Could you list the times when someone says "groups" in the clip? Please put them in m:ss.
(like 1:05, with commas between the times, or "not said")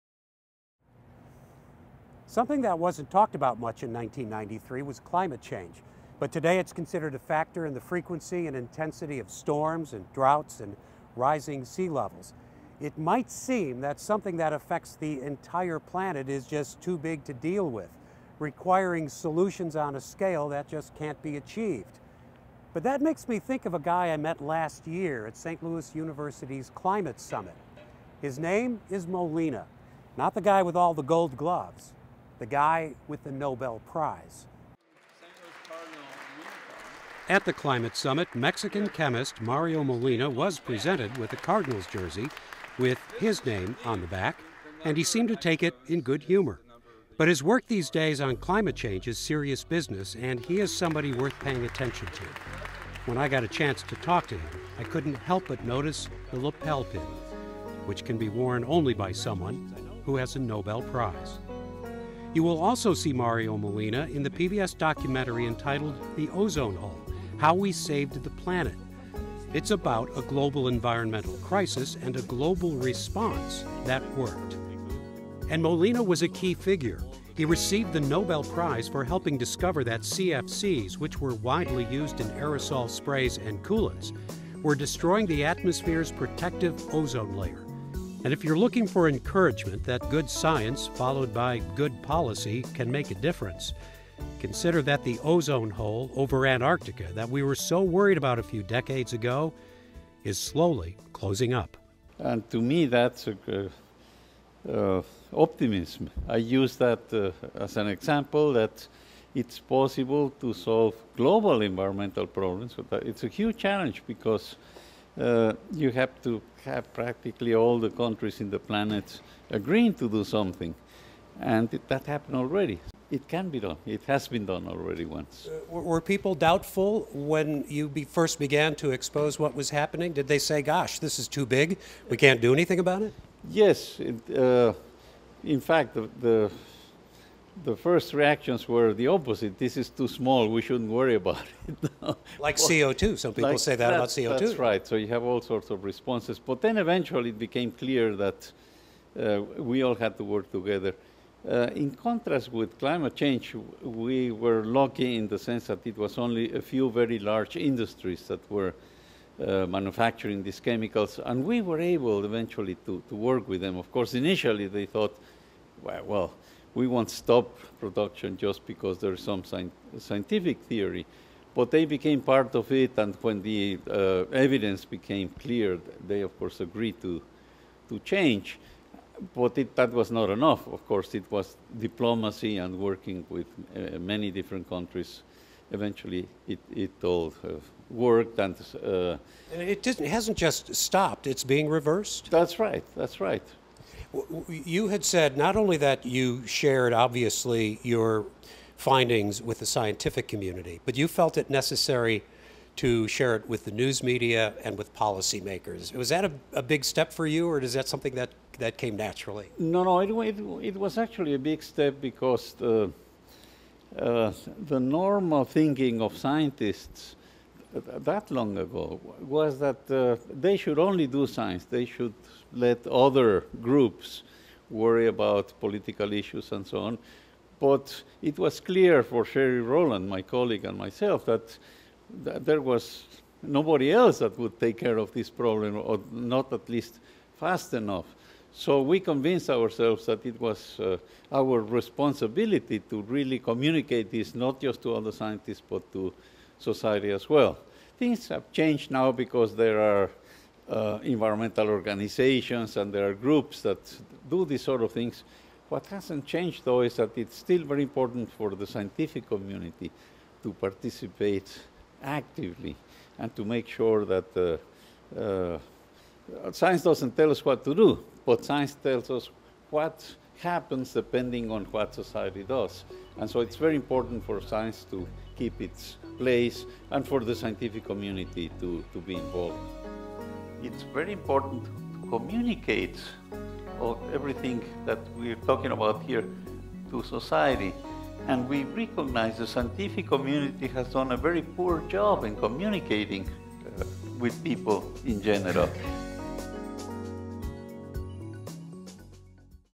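3:43, 4:13.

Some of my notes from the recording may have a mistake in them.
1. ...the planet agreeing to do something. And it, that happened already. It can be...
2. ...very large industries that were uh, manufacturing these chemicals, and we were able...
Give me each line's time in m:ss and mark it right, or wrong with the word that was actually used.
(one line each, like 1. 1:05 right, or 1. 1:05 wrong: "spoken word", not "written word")
1. 1:58 right
2. 2:36 right.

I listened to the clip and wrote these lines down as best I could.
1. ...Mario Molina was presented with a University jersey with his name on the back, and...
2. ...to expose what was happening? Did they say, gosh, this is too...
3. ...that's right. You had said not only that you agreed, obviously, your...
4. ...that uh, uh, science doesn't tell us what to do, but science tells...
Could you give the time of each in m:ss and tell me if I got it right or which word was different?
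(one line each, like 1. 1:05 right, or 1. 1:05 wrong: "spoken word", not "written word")
1. 0:39 wrong: "Cardinals", not "University"
2. 2:08 right
3. 3:12 wrong: "shared", not "agreed"
4. 4:24 right.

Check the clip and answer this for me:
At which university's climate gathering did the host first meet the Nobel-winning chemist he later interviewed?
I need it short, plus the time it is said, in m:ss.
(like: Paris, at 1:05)
St. Louis University, at 0:25.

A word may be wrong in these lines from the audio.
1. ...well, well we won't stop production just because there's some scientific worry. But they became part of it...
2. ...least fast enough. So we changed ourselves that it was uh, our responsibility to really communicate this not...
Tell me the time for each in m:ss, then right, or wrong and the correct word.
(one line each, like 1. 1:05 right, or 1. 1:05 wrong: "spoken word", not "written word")
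1. 2:45 wrong: "theory", not "worry"
2. 3:56 wrong: "convinced", not "changed".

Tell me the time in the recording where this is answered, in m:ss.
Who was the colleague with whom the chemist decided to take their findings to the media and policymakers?
3:49.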